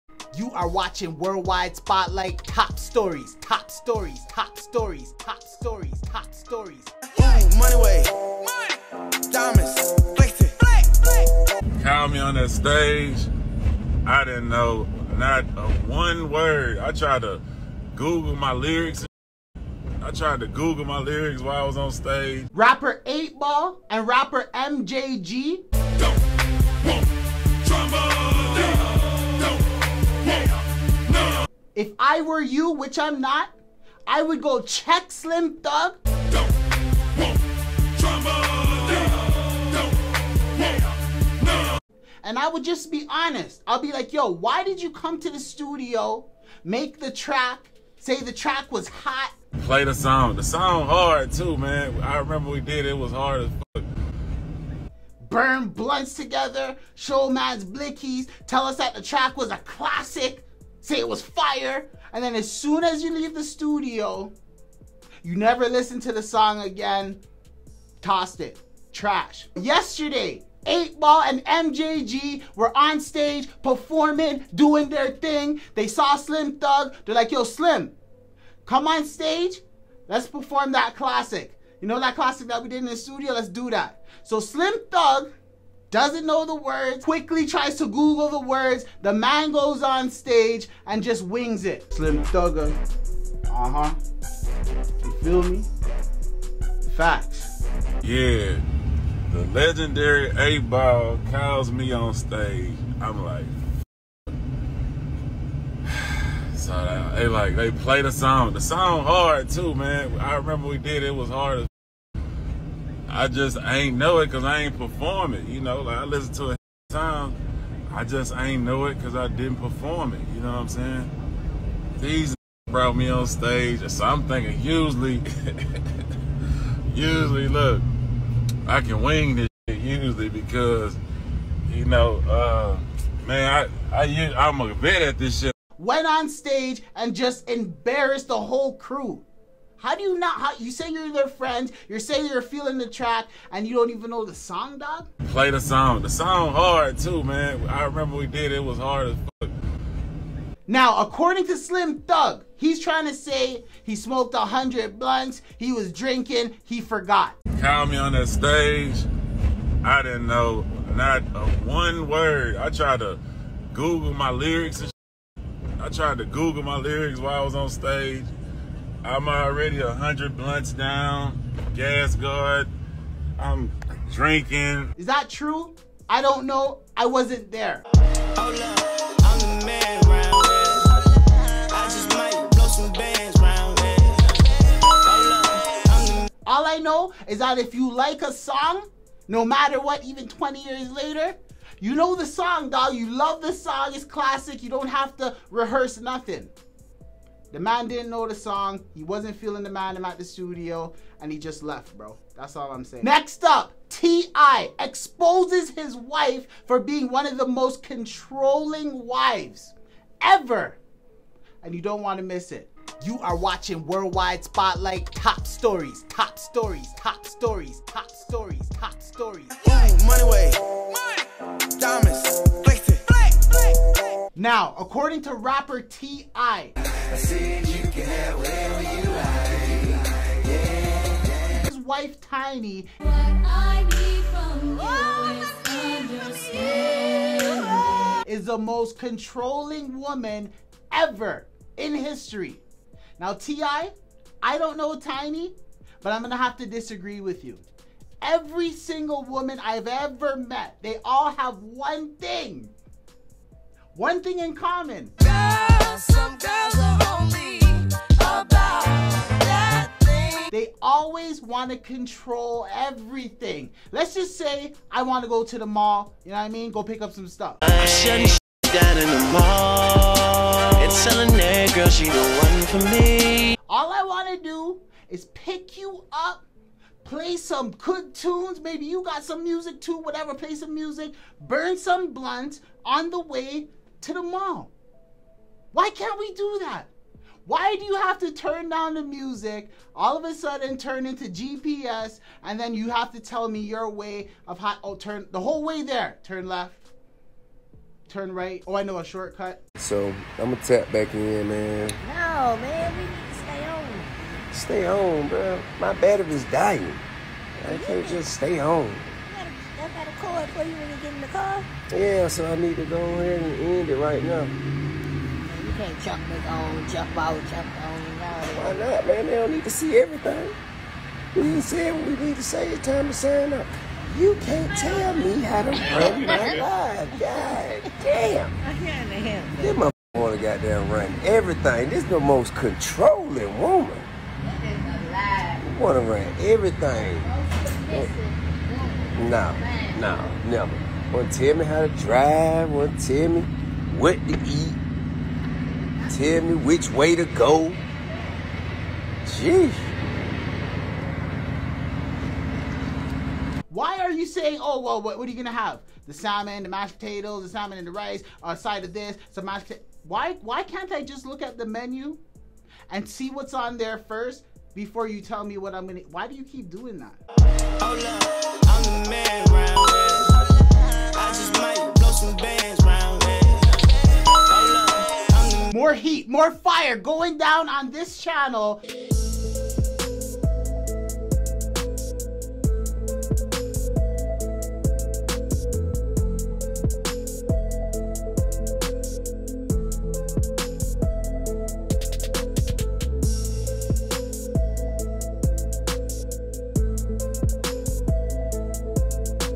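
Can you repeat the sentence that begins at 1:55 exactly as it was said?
You know, like I listen to it time.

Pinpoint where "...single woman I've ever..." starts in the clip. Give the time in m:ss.
4:08.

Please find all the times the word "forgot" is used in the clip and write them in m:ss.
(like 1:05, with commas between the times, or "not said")
2:36.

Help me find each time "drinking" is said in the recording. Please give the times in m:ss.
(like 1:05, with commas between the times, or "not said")
2:35, 2:54.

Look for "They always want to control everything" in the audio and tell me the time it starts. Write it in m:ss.
4:20.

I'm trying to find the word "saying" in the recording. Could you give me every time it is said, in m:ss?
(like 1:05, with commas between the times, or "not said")
2:00, 2:21, 3:22, 5:54.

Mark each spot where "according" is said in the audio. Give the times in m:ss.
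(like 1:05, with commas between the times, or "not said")
2:31, 3:44.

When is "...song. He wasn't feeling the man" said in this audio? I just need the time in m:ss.
3:18.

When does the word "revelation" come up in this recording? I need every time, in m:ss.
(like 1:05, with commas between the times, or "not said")
not said.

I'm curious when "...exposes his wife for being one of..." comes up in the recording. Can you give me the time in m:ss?
3:24.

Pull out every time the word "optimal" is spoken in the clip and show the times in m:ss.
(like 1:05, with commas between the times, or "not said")
not said.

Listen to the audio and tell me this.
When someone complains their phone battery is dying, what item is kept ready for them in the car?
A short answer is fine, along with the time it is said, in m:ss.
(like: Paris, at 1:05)
A cord, at 5:10.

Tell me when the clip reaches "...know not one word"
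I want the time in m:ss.
2:40.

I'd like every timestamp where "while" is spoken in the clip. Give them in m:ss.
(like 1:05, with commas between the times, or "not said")
0:21, 2:47.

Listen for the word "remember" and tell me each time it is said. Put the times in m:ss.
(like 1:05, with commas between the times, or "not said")
0:52, 1:50, 2:27.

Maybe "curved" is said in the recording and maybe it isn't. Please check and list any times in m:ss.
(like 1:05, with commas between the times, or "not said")
not said.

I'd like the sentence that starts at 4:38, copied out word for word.
Maybe you got some music too, whatever.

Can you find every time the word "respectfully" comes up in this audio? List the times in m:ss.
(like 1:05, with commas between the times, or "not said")
not said.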